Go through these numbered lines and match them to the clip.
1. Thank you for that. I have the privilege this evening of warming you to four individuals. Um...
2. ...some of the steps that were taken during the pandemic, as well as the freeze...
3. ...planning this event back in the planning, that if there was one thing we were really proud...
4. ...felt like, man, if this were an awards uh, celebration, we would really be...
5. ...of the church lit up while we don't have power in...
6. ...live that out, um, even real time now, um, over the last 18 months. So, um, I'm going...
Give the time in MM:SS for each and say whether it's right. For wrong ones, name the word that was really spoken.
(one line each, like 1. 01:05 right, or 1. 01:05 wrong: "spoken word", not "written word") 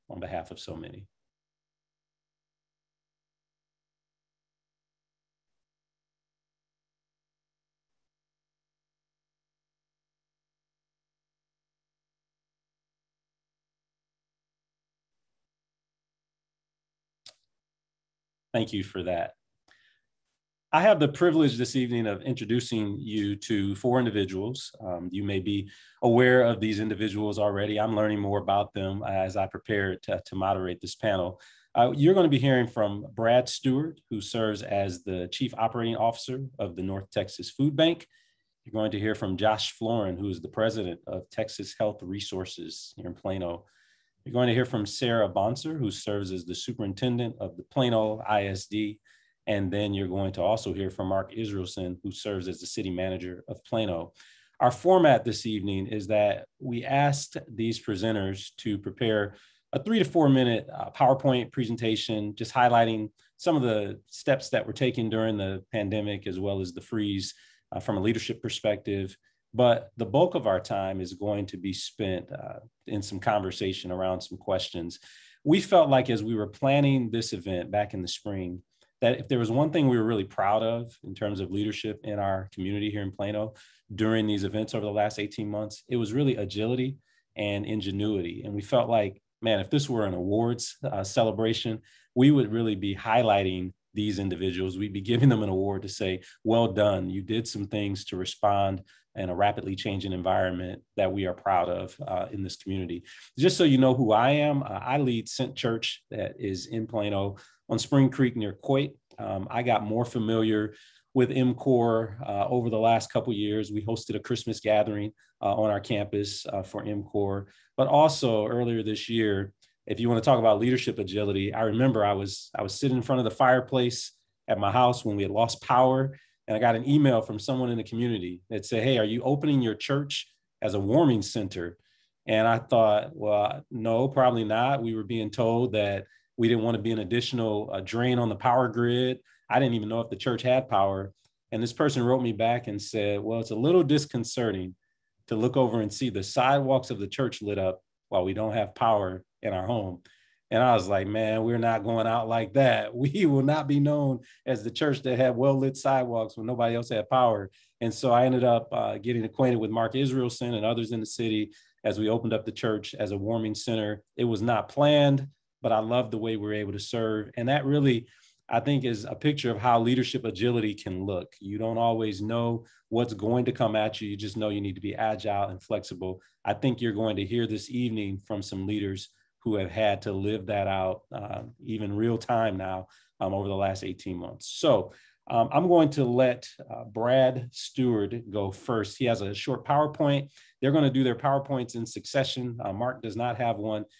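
1. 00:18 wrong: "introducing", not "warming"
2. 01:03 right
3. 01:16 wrong: "spring", not "planning"
4. 01:28 right
5. 02:26 right
6. 03:00 right.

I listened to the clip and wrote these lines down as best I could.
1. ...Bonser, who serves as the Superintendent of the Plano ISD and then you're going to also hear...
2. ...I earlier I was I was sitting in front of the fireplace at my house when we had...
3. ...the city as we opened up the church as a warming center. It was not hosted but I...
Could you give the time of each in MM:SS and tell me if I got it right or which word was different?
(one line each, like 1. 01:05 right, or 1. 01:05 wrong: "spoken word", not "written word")
1. 00:45 right
2. 02:01 wrong: "remember", not "earlier"
3. 02:41 wrong: "planned", not "hosted".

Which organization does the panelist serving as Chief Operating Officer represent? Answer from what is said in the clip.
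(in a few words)
North Texas Food Bank.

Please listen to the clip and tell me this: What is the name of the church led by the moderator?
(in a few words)
Sent Church.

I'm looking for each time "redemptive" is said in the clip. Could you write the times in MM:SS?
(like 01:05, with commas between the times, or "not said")
not said.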